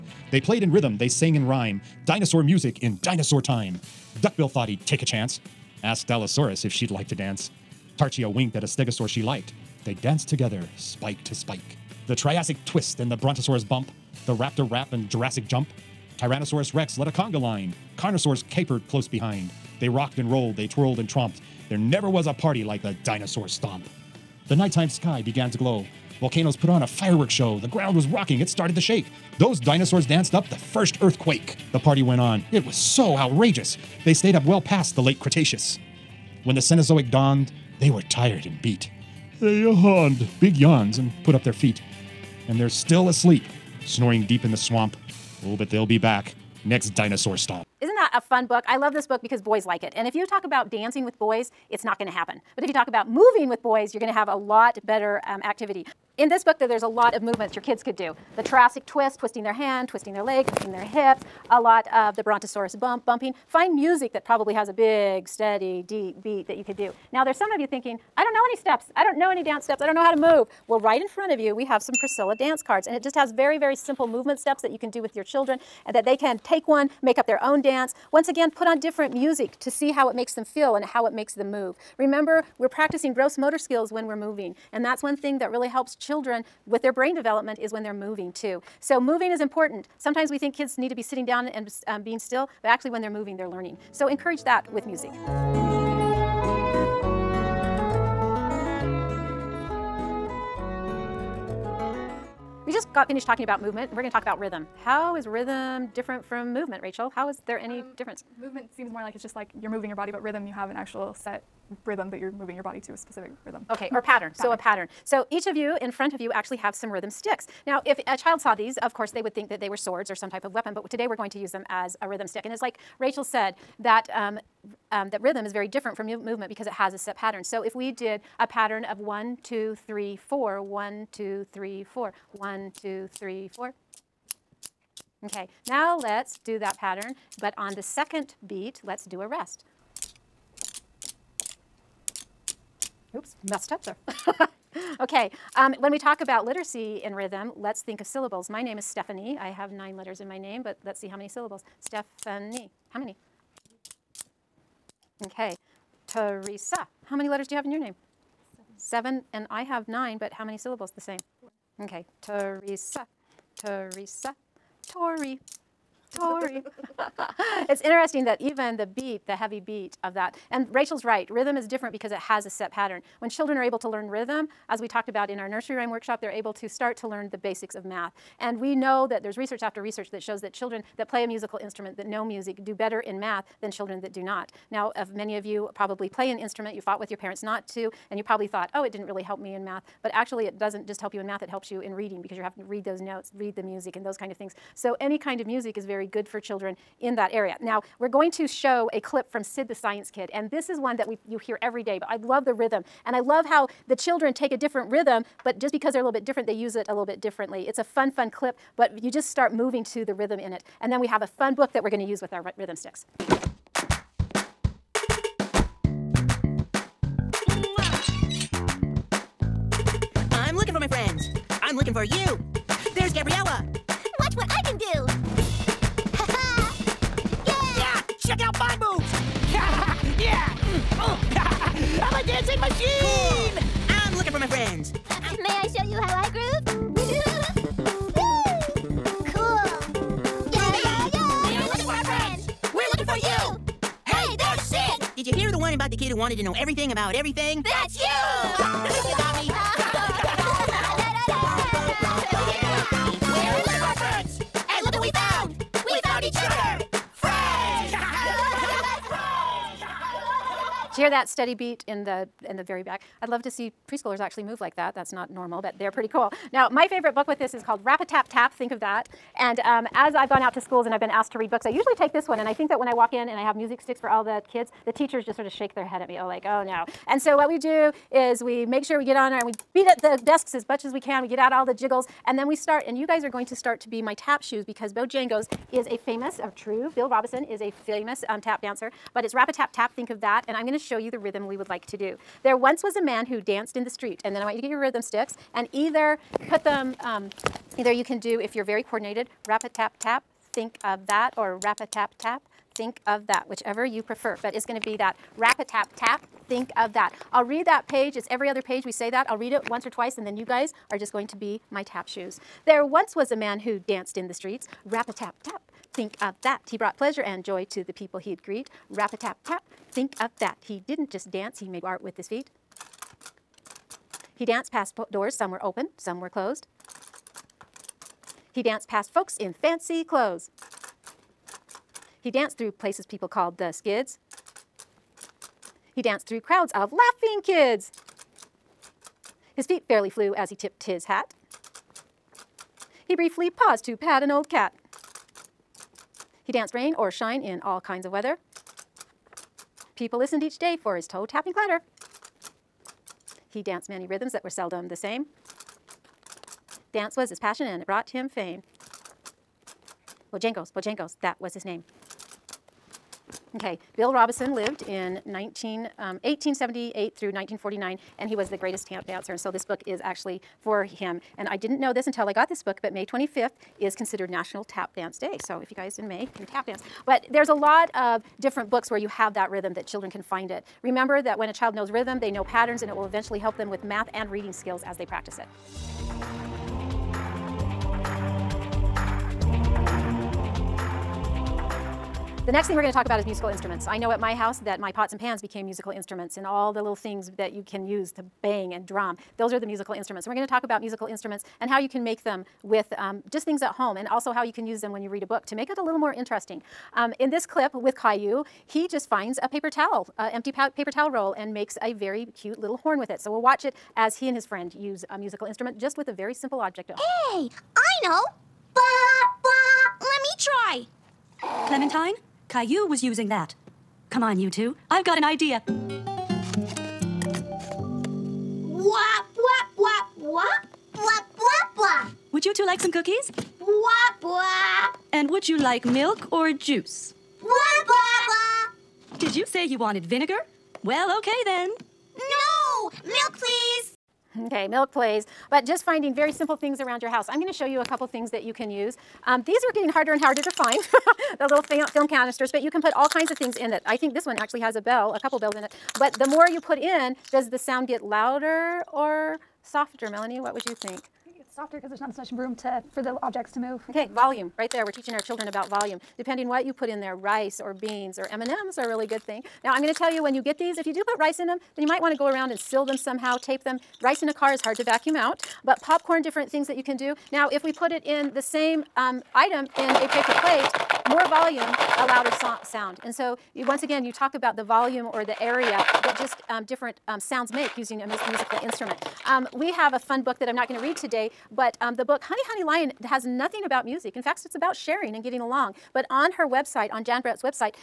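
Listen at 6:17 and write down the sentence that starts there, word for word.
But there's a lot of different books where you have that rhythm that children can find it.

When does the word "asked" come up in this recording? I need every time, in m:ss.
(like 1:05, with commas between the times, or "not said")
0:05, 4:31.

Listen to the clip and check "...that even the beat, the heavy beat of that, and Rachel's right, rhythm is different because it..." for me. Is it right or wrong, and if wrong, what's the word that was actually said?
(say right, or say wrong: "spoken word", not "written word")
right.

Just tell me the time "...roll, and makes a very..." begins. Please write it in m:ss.
6:51.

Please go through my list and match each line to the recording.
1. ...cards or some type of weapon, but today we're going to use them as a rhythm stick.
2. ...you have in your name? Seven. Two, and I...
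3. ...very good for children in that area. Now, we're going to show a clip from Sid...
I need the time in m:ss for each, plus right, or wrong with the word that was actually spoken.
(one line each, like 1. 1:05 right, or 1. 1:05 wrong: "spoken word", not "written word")
1. 1:59 wrong: "swords", not "cards"
2. 2:37 wrong: "Seven", not "Two"
3. 3:15 right.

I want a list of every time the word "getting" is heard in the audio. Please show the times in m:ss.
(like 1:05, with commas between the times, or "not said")
7:29, 8:15.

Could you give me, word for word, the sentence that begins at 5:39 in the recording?
His feet fairly flew as he tipped his hat.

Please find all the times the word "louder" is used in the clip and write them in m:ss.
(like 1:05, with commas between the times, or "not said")
7:38, 8:02.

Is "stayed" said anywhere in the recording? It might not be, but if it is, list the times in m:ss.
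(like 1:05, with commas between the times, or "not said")
0:34.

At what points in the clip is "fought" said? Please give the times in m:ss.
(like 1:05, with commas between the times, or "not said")
3:06.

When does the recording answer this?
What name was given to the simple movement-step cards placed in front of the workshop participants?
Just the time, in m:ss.
1:12.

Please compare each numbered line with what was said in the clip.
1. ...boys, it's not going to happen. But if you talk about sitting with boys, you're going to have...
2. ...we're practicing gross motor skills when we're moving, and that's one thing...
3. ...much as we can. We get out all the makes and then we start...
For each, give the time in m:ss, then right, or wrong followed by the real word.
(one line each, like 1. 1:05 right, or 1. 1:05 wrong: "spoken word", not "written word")
1. 0:51 wrong: "moving", not "sitting"
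2. 1:22 right
3. 4:40 wrong: "jiggles", not "makes".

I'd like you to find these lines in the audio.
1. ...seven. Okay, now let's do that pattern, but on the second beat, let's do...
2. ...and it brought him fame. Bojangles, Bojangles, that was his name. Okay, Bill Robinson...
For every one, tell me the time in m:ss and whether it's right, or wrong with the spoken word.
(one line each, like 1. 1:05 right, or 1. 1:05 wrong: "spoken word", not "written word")
1. 2:13 wrong: "four", not "seven"
2. 5:57 right.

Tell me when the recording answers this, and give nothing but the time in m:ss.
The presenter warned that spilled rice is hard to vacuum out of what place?
7:54.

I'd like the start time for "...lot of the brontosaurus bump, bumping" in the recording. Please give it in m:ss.
1:01.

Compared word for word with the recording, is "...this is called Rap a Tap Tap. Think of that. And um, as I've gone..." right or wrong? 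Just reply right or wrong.
right.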